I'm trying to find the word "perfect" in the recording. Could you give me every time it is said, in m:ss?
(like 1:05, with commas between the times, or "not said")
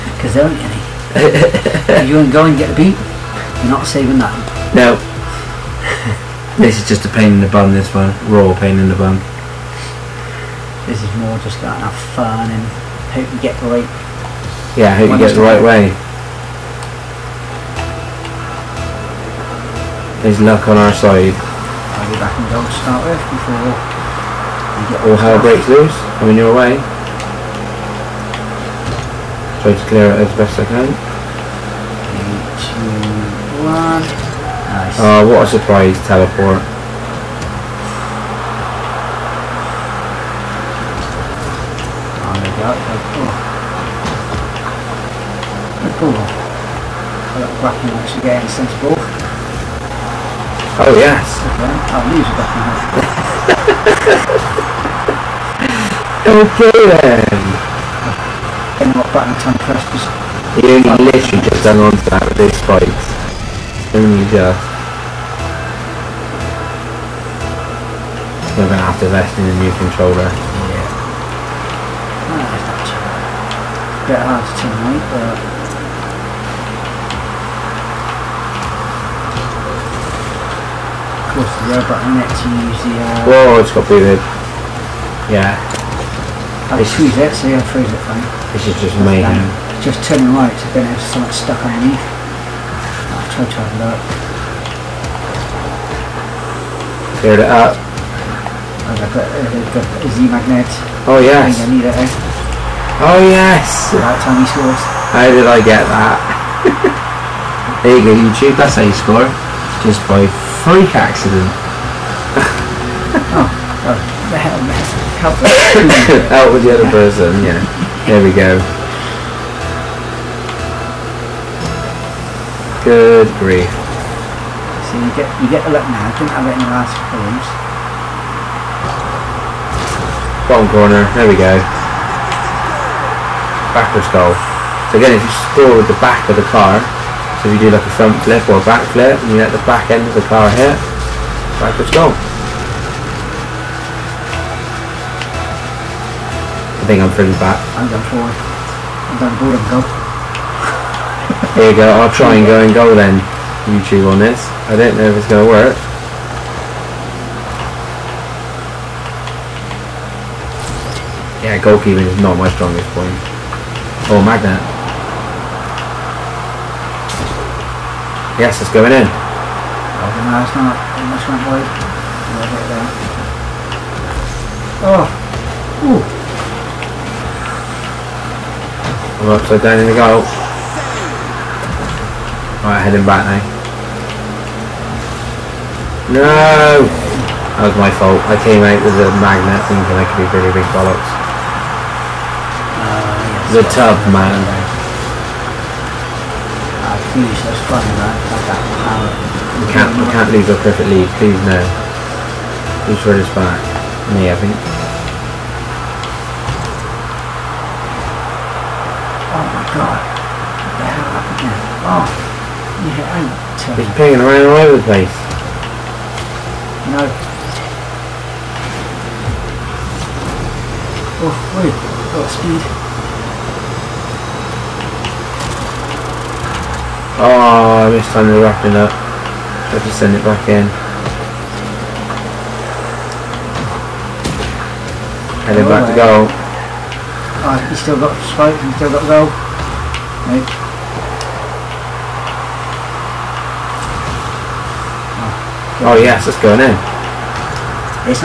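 3:20.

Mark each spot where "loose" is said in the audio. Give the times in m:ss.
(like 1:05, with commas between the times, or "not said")
0:25.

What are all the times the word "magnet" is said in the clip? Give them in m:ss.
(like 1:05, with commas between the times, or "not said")
1:40, 2:44, 3:09.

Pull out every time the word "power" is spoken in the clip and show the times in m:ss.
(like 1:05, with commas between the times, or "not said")
3:17.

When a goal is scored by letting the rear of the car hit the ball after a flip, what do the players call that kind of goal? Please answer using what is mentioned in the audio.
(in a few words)
Backwards goal.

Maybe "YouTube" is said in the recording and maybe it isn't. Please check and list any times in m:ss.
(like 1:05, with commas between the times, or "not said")
1:48, 2:33.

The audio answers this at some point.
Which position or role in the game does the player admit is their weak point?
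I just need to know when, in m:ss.
2:41.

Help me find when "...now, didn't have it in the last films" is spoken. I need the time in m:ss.
2:05.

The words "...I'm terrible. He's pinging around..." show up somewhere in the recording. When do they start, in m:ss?
3:33.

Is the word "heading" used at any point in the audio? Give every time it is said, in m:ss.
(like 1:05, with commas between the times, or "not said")
3:02, 3:55.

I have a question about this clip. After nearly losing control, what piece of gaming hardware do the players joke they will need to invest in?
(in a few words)
A new controller.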